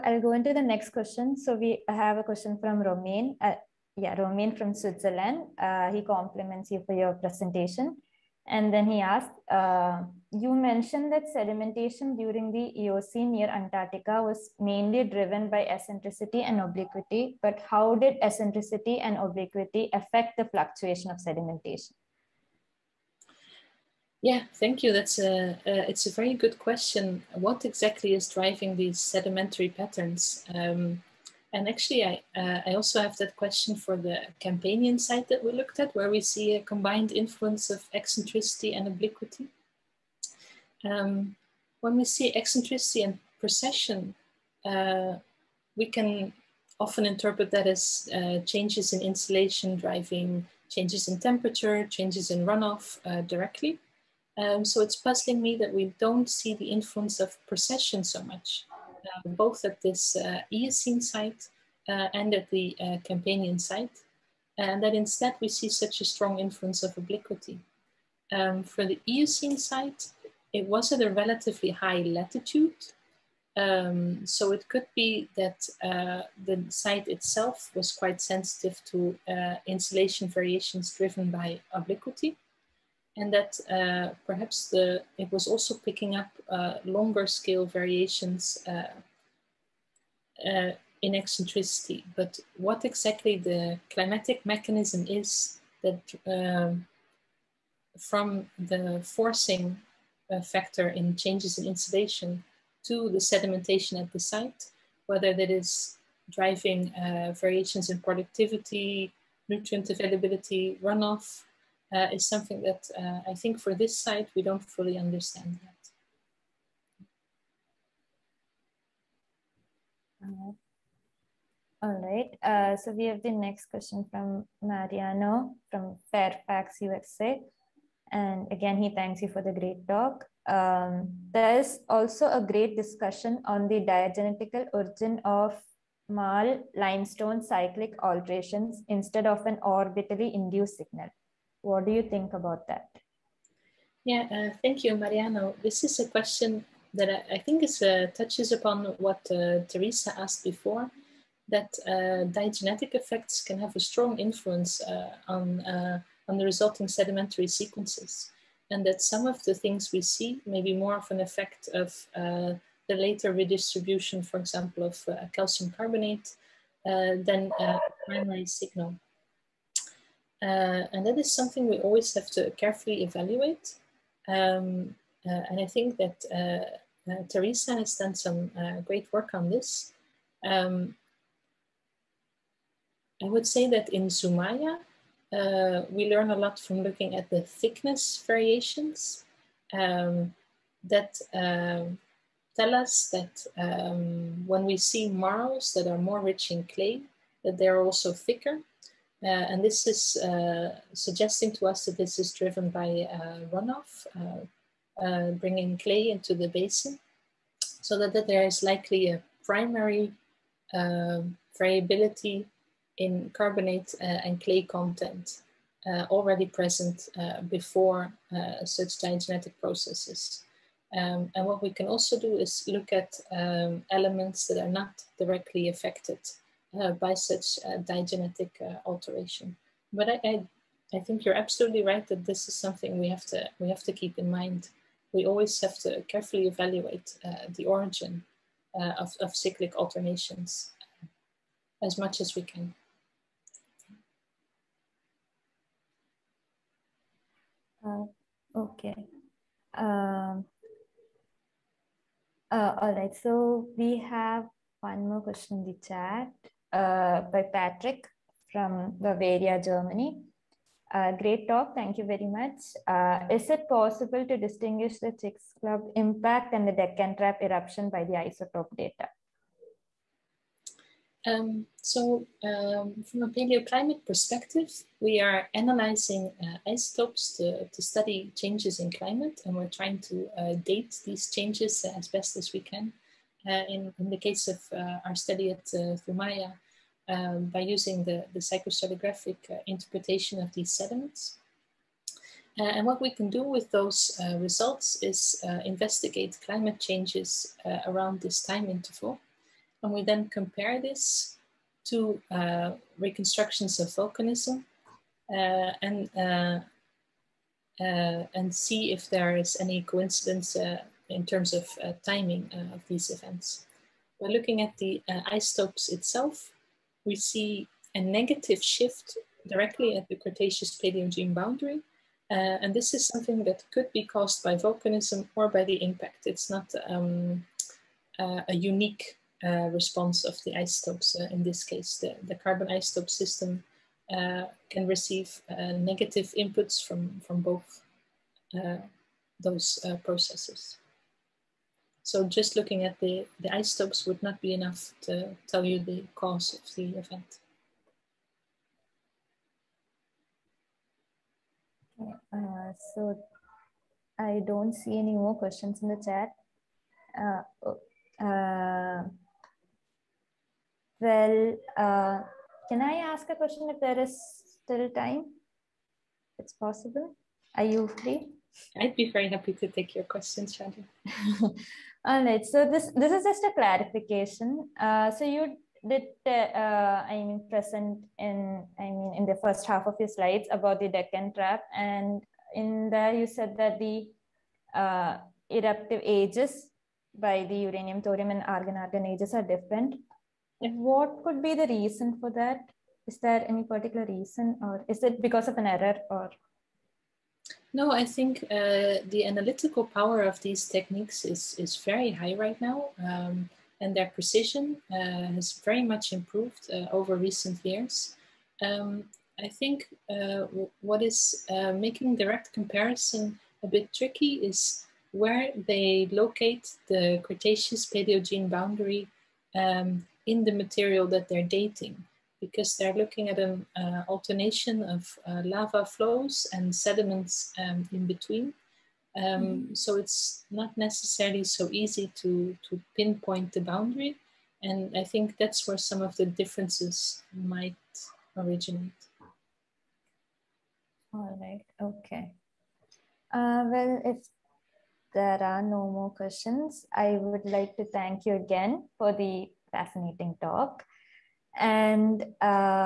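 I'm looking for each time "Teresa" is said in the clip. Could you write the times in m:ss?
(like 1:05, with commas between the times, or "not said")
2:29, 2:57.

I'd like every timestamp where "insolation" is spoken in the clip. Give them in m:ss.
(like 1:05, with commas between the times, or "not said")
0:49, 1:19, 1:41.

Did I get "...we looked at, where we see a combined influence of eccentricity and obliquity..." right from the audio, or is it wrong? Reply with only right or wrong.
right.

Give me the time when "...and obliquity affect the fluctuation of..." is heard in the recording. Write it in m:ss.
0:19.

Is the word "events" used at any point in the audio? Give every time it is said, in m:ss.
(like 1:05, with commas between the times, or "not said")
5:13, 5:46.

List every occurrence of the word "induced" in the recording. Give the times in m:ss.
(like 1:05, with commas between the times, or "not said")
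2:20.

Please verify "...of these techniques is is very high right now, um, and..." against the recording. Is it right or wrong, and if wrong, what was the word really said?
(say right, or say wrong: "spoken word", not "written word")
right.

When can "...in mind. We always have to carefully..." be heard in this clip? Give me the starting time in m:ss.
3:54.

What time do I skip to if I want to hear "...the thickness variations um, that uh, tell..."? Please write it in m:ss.
3:07.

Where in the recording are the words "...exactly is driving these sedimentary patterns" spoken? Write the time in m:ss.
0:27.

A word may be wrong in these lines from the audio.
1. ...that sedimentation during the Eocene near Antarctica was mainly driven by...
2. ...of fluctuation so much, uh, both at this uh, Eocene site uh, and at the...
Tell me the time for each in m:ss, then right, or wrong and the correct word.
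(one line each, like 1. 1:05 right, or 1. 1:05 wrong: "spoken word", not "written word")
1. 0:11 right
2. 0:57 wrong: "precession", not "fluctuation".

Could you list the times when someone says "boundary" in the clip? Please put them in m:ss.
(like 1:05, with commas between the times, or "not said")
5:21, 6:58, 7:13.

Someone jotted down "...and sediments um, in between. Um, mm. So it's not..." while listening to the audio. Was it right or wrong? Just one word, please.
right.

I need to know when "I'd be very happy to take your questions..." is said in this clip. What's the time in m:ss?
6:08.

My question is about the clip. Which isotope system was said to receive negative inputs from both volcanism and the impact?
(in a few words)
carbon isotope system.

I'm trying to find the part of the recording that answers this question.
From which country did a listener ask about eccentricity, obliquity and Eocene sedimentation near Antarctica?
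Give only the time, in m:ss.
0:04.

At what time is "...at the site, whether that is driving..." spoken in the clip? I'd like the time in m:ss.
1:44.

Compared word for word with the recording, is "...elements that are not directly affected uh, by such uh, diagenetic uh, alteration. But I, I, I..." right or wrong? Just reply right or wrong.
right.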